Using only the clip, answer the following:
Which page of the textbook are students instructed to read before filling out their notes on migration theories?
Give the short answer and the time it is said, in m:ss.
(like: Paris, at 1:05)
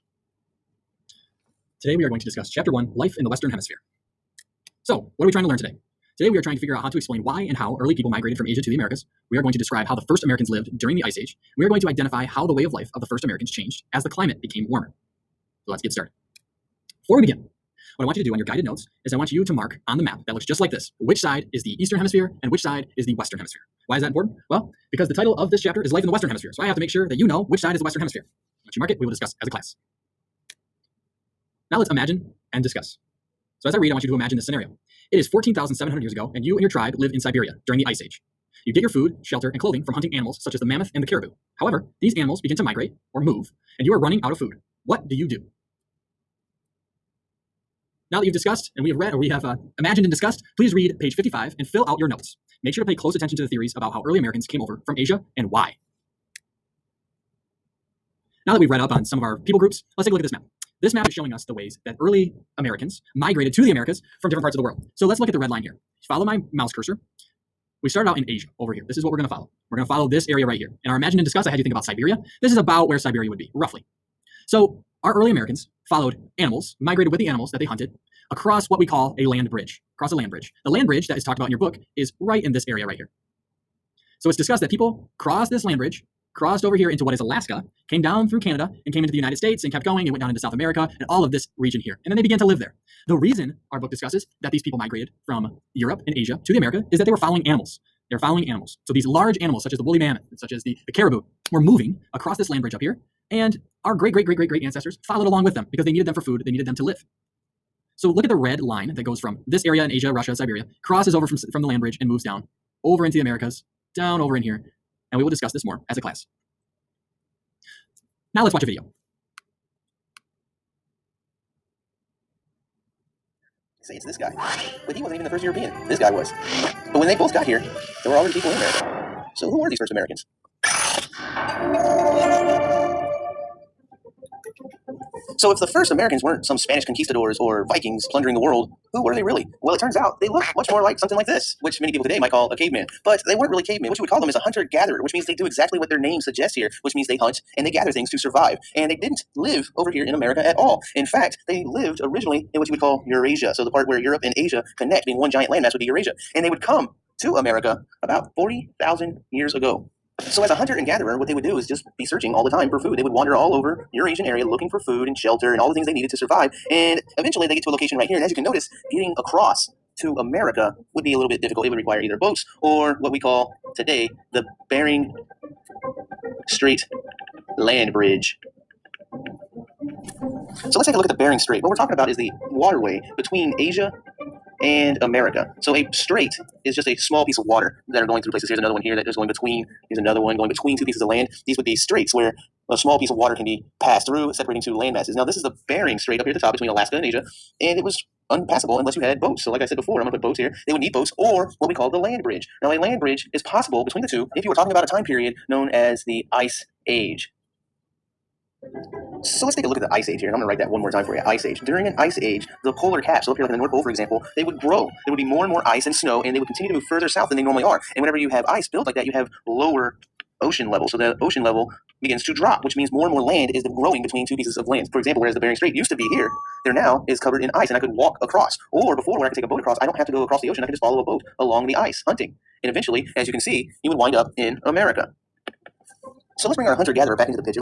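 55, at 0:51.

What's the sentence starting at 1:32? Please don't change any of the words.
And then they began to live there.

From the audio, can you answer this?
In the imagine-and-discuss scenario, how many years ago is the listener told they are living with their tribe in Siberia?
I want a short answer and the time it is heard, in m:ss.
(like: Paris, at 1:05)
14,700, at 0:35.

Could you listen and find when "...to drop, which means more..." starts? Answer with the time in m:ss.
3:42.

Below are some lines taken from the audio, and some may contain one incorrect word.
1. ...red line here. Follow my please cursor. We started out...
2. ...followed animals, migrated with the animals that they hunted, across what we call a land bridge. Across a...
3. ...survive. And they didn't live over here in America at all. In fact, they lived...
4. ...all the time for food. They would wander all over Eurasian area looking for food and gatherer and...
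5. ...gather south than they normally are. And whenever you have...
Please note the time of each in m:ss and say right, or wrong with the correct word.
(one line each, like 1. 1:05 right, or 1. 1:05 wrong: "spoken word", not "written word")
1. 1:05 wrong: "mouse", not "please"
2. 1:15 right
3. 2:28 right
4. 2:42 wrong: "shelter", not "gatherer"
5. 3:36 wrong: "further", not "gather".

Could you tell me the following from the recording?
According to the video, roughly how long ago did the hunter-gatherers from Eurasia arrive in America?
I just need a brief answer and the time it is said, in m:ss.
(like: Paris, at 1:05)
40,000 years ago, at 2:38.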